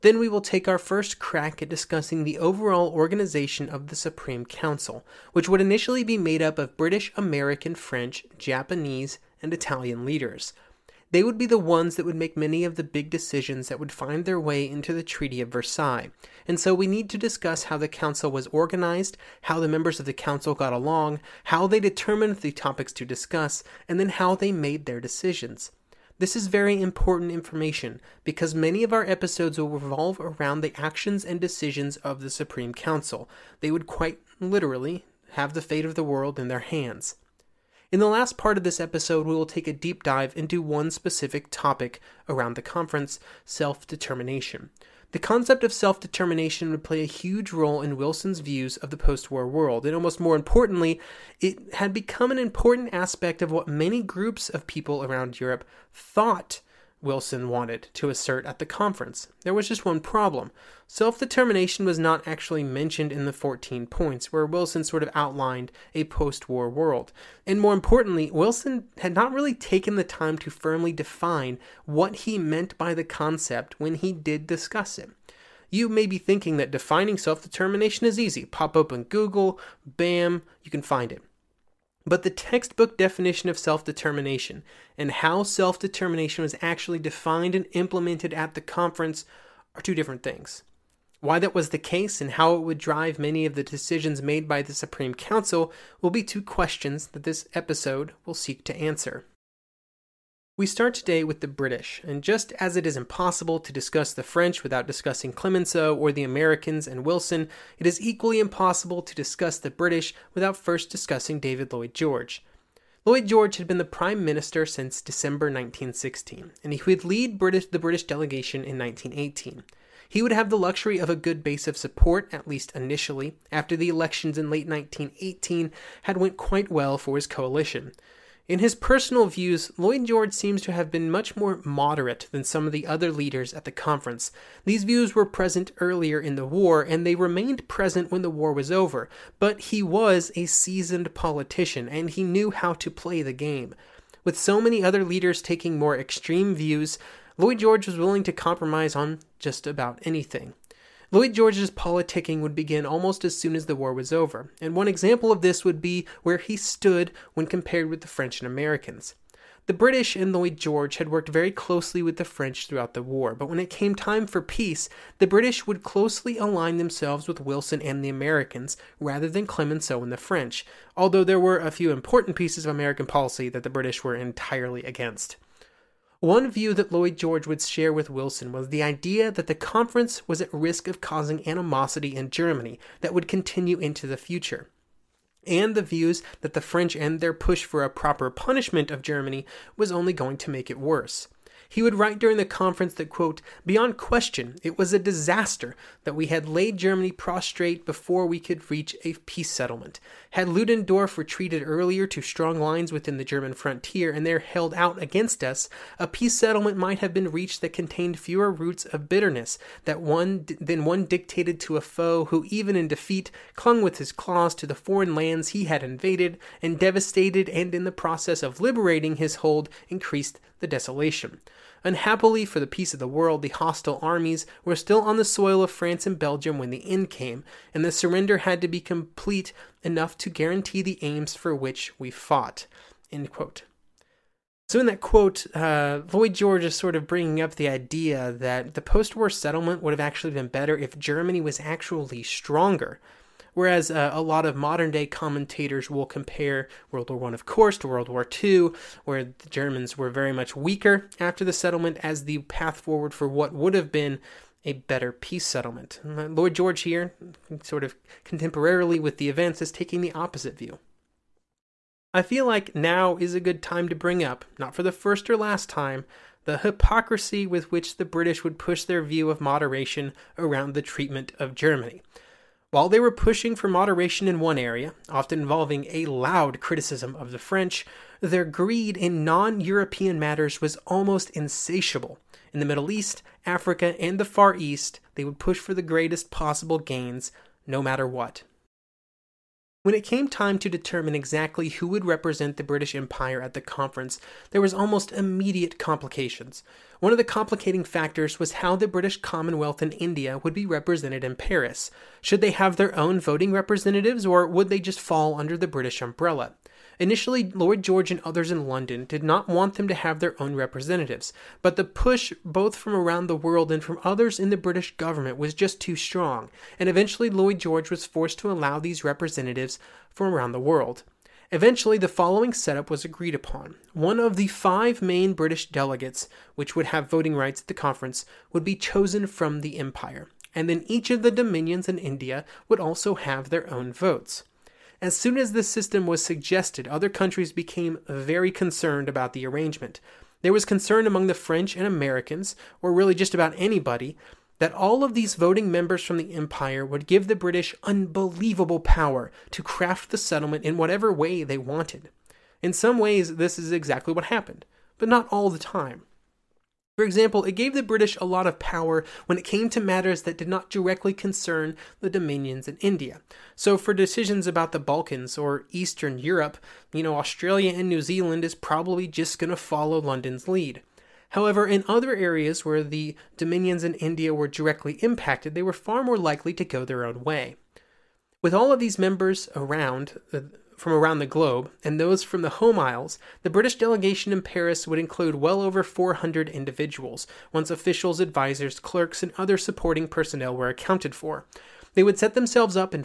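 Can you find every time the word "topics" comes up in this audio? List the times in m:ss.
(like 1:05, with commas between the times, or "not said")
0:22, 0:41.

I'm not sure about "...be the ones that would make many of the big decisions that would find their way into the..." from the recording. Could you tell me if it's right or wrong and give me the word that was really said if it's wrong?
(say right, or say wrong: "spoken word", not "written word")
right.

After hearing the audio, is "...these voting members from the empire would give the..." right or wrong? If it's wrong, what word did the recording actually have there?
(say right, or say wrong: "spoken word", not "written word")
right.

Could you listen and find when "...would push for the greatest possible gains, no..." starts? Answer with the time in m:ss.
4:45.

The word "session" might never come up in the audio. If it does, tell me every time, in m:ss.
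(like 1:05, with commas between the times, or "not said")
not said.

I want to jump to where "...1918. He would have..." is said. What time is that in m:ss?
1:58.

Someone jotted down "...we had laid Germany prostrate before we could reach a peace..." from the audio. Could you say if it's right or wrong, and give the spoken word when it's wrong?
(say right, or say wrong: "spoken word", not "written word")
right.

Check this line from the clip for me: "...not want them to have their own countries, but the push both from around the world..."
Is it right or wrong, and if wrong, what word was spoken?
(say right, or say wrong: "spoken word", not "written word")
wrong: "representatives", not "countries".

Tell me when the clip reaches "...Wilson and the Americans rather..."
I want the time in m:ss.
2:47.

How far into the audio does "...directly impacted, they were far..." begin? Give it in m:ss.
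6:14.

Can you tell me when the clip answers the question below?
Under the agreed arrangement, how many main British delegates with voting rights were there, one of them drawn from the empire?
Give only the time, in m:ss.
5:24.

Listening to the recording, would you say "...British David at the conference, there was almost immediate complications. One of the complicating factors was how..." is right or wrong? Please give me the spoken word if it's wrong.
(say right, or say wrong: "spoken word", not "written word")
wrong: "Empire", not "David".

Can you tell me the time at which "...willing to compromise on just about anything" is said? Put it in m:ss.
2:27.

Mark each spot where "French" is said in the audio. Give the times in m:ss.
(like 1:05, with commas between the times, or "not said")
0:07, 1:44, 2:38, 2:42, 2:50, 3:06, 4:37, 5:41.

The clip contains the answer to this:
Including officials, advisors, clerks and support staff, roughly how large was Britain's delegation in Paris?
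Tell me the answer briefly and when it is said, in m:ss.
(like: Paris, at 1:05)
Over 400, at 6:25.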